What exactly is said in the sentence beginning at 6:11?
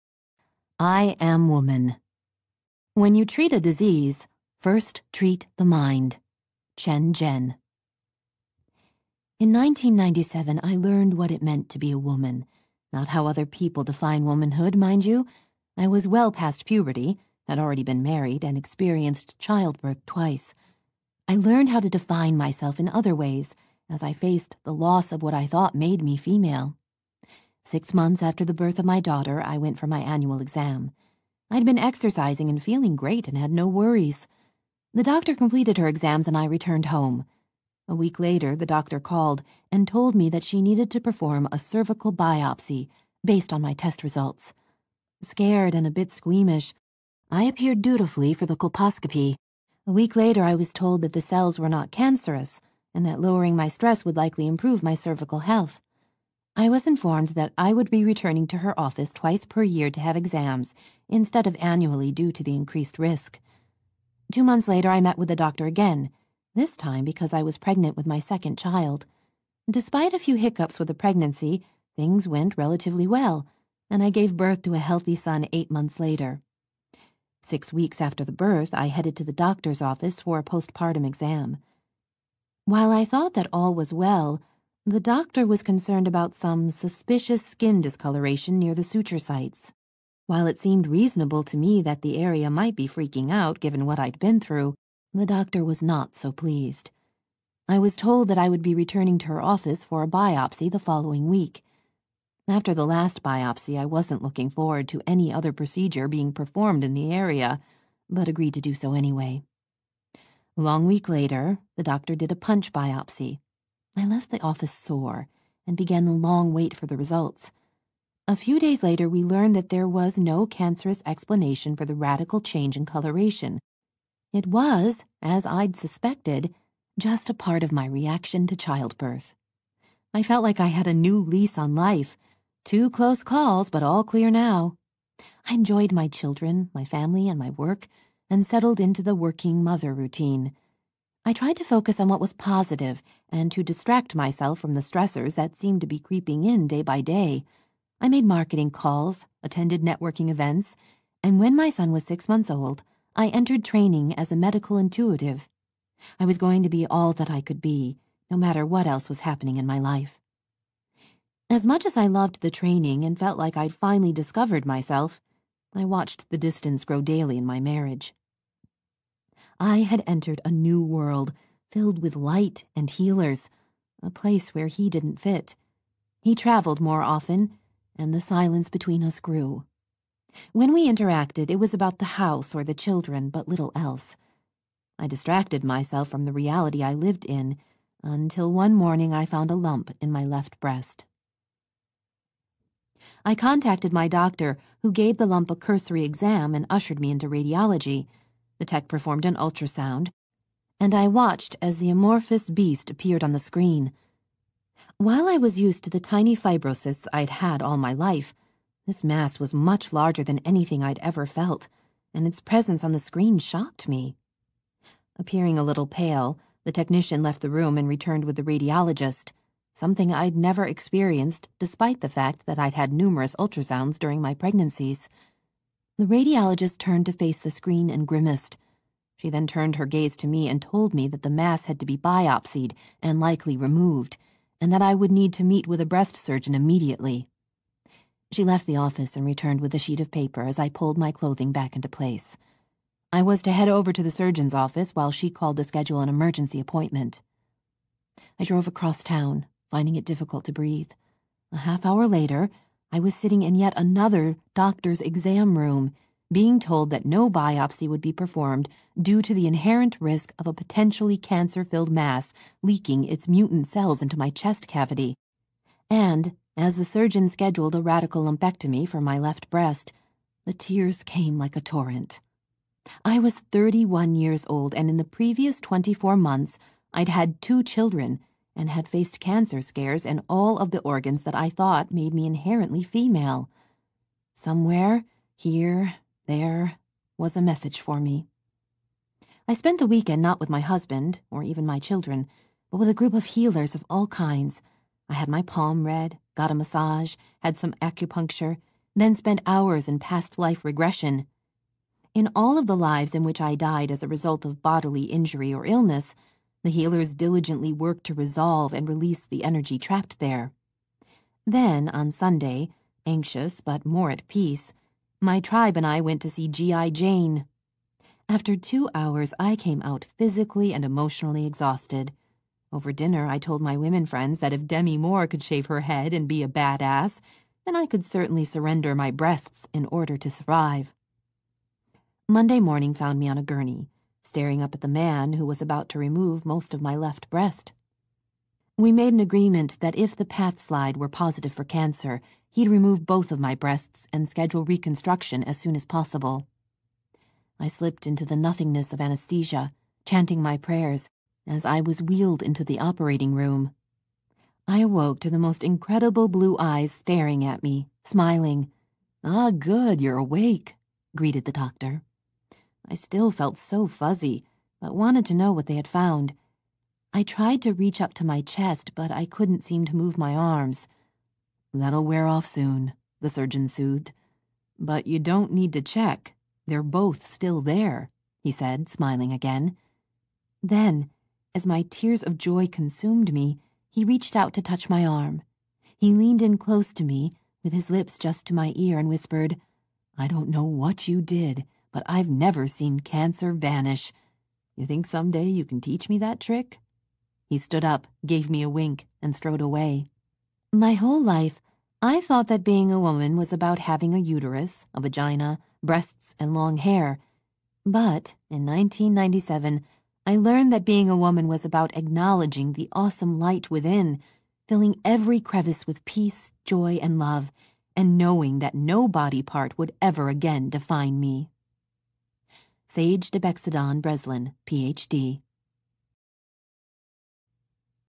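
That'll wear off soon, the surgeon soothed.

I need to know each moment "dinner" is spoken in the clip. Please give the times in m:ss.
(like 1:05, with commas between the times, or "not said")
5:22.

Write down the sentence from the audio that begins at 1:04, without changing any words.
Two months later, I met with the doctor again, this time because I was pregnant with my second child.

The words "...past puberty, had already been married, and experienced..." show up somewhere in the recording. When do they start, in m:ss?
0:16.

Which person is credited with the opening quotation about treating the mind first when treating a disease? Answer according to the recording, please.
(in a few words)
Chen Zhen.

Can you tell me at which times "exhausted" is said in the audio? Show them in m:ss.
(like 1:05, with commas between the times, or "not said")
5:21.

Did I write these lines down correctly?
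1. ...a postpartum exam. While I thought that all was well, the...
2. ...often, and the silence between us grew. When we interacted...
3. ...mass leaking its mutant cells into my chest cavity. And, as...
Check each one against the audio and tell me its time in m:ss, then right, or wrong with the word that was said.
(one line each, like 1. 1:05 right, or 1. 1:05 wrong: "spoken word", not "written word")
1. 1:20 right
2. 2:57 right
3. 4:21 right.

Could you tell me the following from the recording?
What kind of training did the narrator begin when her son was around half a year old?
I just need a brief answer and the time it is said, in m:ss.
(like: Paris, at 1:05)
medical intuitive, at 2:34.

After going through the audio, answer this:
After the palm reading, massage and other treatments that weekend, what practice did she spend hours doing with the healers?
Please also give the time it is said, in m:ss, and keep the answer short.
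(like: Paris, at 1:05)
past life regression, at 4:59.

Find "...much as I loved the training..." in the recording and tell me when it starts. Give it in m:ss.
2:41.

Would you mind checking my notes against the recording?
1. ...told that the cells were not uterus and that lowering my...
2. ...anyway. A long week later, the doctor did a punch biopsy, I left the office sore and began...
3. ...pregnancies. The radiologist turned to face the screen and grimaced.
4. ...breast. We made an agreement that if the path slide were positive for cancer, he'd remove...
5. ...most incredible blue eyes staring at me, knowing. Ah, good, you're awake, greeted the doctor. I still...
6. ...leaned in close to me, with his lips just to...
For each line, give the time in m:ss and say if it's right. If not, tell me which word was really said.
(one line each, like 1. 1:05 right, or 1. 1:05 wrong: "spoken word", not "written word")
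1. 0:50 wrong: "cancerous", not "uterus"
2. 1:48 right
3. 3:44 right
4. 5:37 right
5. 5:55 wrong: "smiling", not "knowing"
6. 6:26 right.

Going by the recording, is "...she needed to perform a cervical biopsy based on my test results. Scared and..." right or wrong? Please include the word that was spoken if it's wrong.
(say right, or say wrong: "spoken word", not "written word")
right.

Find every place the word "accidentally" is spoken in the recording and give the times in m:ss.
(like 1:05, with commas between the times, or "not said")
not said.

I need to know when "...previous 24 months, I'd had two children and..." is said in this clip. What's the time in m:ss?
4:35.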